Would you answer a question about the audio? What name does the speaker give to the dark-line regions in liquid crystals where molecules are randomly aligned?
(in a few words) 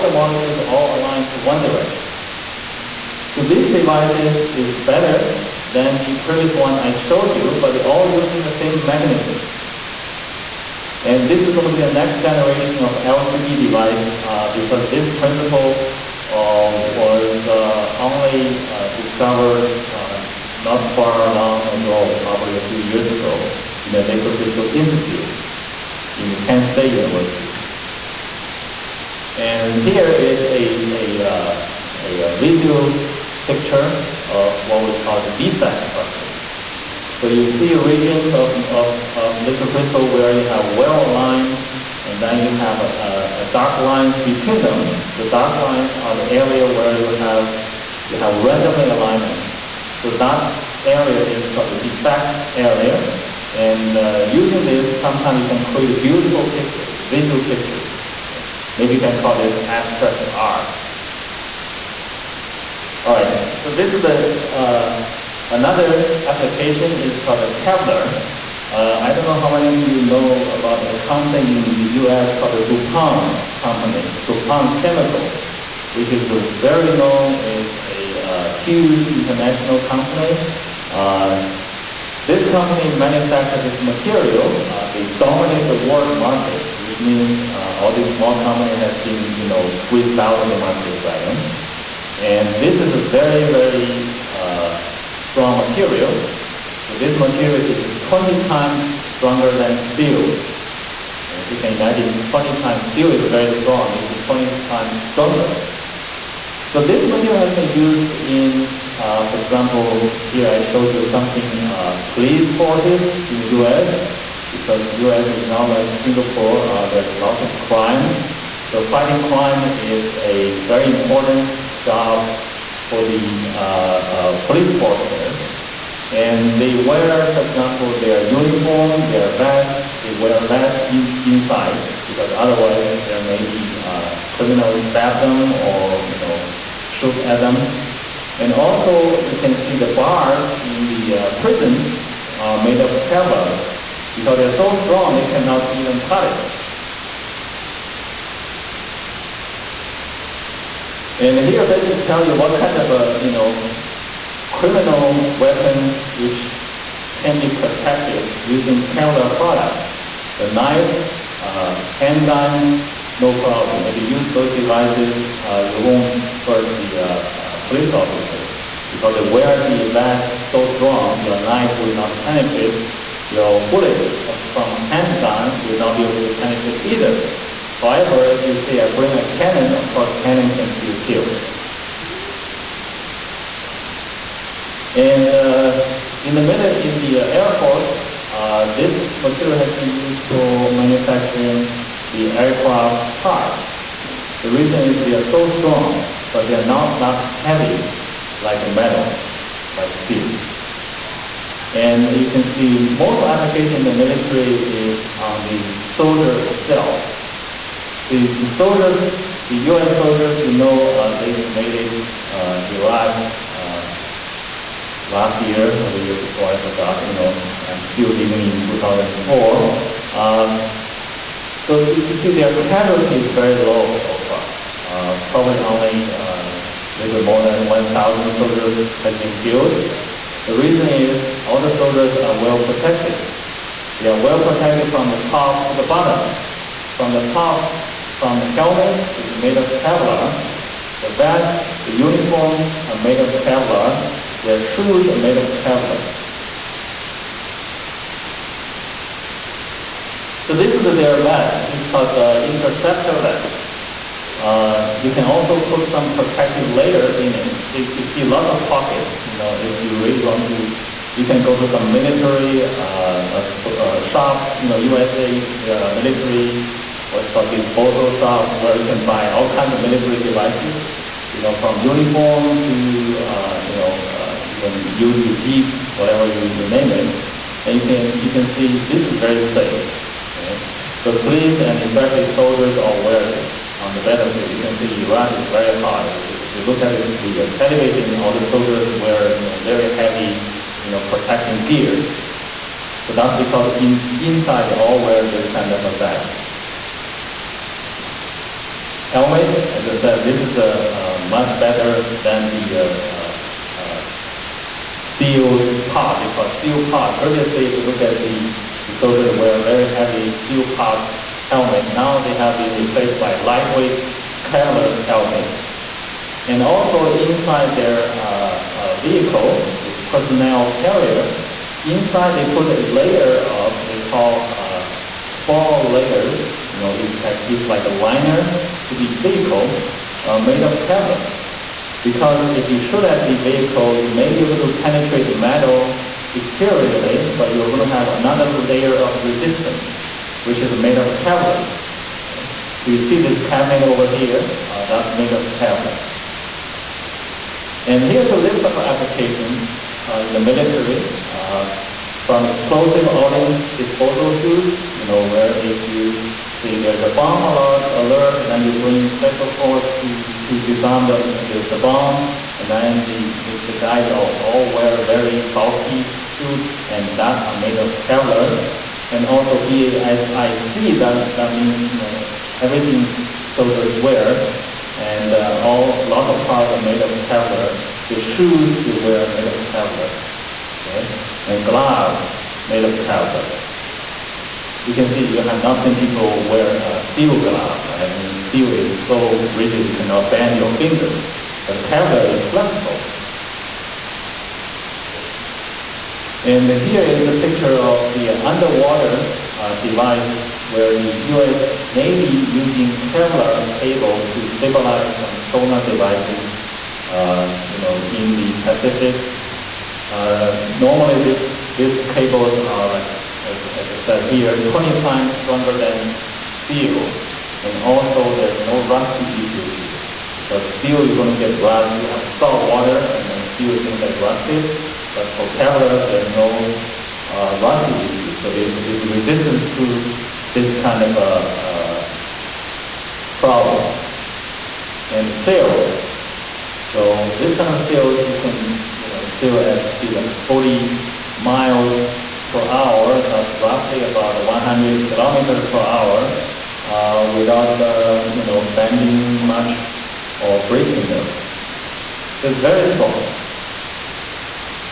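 defect area.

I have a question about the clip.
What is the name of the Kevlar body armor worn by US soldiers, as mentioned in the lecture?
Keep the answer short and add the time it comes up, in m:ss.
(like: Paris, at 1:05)
interceptor vest, at 4:12.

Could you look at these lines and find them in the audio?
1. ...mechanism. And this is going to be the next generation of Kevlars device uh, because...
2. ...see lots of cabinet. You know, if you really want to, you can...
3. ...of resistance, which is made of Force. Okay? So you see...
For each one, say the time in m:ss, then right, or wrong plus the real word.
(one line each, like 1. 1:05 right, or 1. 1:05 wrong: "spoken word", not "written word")
1. 0:08 wrong: "LCD", not "Kevlars"
2. 4:18 wrong: "pocket", not "cabinet"
3. 5:38 wrong: "Kevlar", not "Force".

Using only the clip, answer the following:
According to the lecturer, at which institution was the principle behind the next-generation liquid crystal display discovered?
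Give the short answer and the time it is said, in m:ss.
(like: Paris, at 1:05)
Kent State University, at 0:26.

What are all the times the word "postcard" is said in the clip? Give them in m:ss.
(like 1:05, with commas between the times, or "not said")
not said.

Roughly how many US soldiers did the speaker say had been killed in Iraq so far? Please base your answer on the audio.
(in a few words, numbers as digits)
1,000.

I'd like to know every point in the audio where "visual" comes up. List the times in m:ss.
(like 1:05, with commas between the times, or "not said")
0:32, 0:56.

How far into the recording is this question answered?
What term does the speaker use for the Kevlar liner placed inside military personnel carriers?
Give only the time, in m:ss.
5:25.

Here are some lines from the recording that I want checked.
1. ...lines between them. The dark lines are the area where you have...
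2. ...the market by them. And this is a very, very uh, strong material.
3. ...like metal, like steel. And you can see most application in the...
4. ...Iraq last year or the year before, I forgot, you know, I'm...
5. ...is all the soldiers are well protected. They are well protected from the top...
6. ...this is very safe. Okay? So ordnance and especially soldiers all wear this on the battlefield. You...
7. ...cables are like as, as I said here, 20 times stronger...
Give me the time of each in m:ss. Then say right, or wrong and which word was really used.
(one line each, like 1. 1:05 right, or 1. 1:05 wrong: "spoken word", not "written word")
1. 0:43 right
2. 1:30 right
3. 3:18 right
4. 3:32 right
5. 3:50 right
6. 4:38 wrong: "police", not "ordnance"
7. 6:52 right.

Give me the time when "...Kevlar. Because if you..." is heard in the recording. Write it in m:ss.
5:30.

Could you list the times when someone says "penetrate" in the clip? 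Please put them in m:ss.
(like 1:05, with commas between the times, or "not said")
2:52, 2:56, 5:34.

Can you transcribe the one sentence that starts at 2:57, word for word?
However, if you say, I bring a cannon, of course cannon can still kill.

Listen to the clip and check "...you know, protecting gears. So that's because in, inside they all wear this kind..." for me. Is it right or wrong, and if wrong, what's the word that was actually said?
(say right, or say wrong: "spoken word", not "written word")
right.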